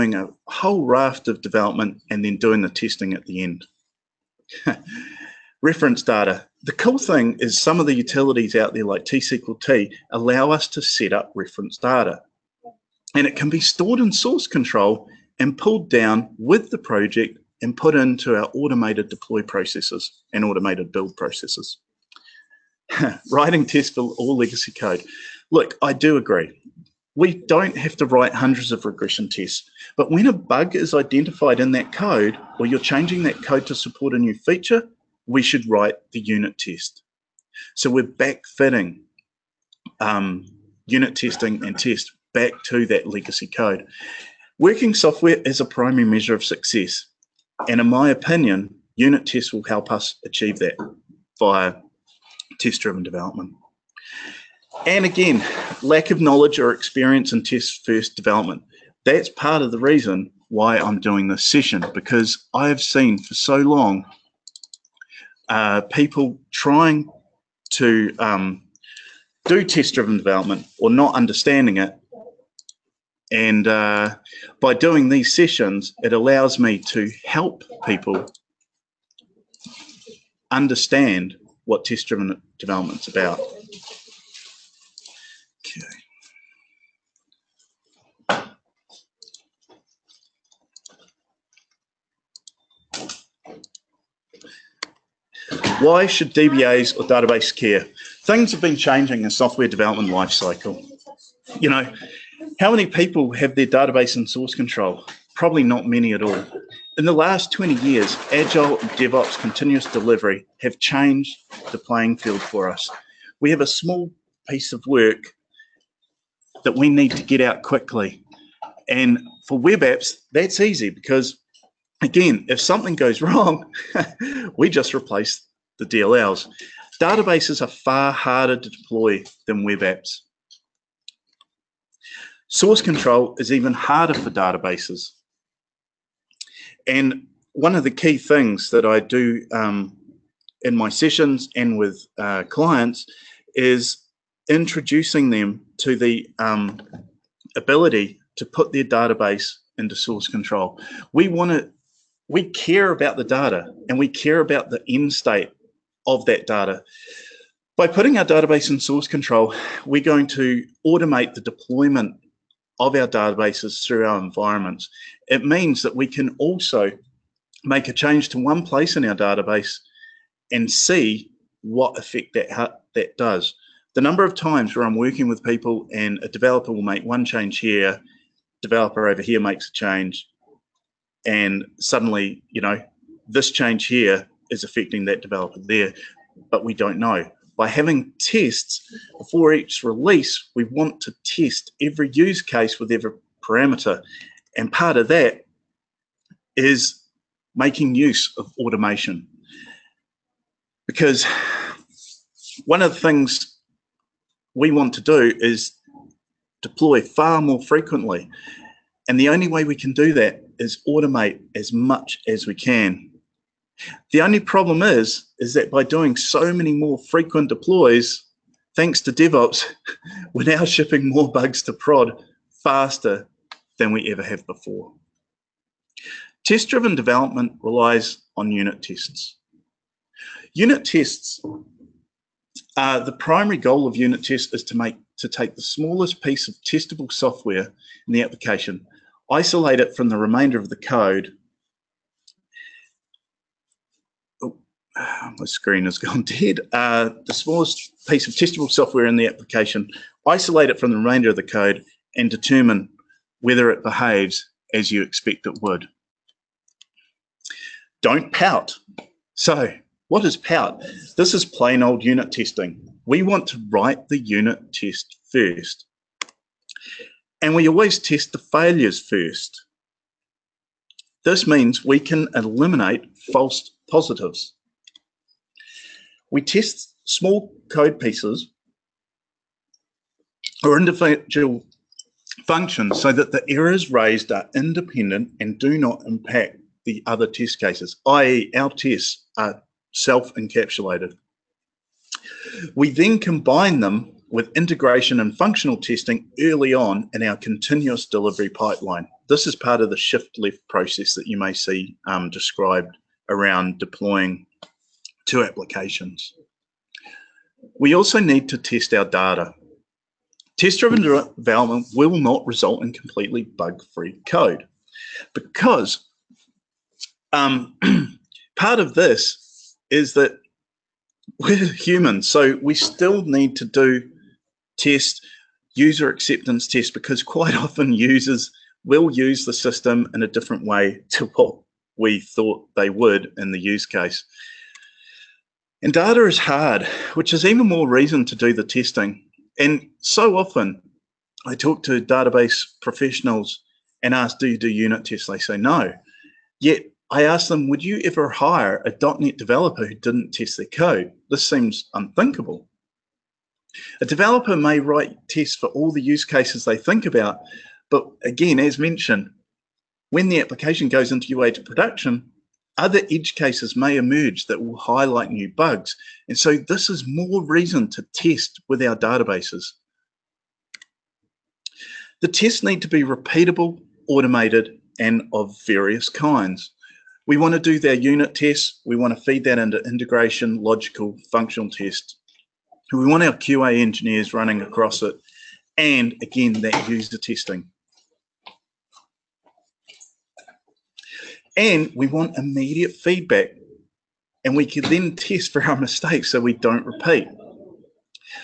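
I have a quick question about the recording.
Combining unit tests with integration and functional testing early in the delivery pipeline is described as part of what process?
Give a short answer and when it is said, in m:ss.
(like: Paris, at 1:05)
Shift left, at 4:59.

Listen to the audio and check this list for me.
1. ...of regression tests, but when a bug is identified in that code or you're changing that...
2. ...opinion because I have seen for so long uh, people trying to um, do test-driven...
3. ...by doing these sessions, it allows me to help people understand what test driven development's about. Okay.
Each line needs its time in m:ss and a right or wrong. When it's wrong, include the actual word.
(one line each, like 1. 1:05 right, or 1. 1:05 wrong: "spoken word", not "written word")
1. 0:28 right
2. 1:01 wrong: "session", not "opinion"
3. 1:14 right.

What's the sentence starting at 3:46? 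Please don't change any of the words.
Test-driven development relies on unit tests.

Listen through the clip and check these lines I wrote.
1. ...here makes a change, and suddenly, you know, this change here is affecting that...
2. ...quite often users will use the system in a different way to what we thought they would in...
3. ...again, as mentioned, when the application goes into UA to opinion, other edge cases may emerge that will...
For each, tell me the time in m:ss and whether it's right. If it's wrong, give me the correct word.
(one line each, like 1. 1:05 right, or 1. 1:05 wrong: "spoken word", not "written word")
1. 2:59 right
2. 5:27 right
3. 5:58 wrong: "production", not "opinion".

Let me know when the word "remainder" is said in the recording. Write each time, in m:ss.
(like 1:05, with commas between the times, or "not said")
4:00, 4:10.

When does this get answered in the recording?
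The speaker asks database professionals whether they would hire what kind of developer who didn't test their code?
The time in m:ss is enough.
5:49.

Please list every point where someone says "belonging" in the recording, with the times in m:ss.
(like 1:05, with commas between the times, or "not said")
not said.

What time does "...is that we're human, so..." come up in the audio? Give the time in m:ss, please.
5:19.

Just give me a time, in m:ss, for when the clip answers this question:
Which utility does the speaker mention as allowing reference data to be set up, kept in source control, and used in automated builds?
0:09.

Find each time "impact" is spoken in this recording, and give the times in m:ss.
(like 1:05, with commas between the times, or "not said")
4:46.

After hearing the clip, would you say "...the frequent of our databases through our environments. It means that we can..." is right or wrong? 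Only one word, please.
wrong.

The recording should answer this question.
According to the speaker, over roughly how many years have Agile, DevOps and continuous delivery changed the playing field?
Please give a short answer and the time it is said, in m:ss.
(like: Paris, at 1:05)
20 years, at 1:47.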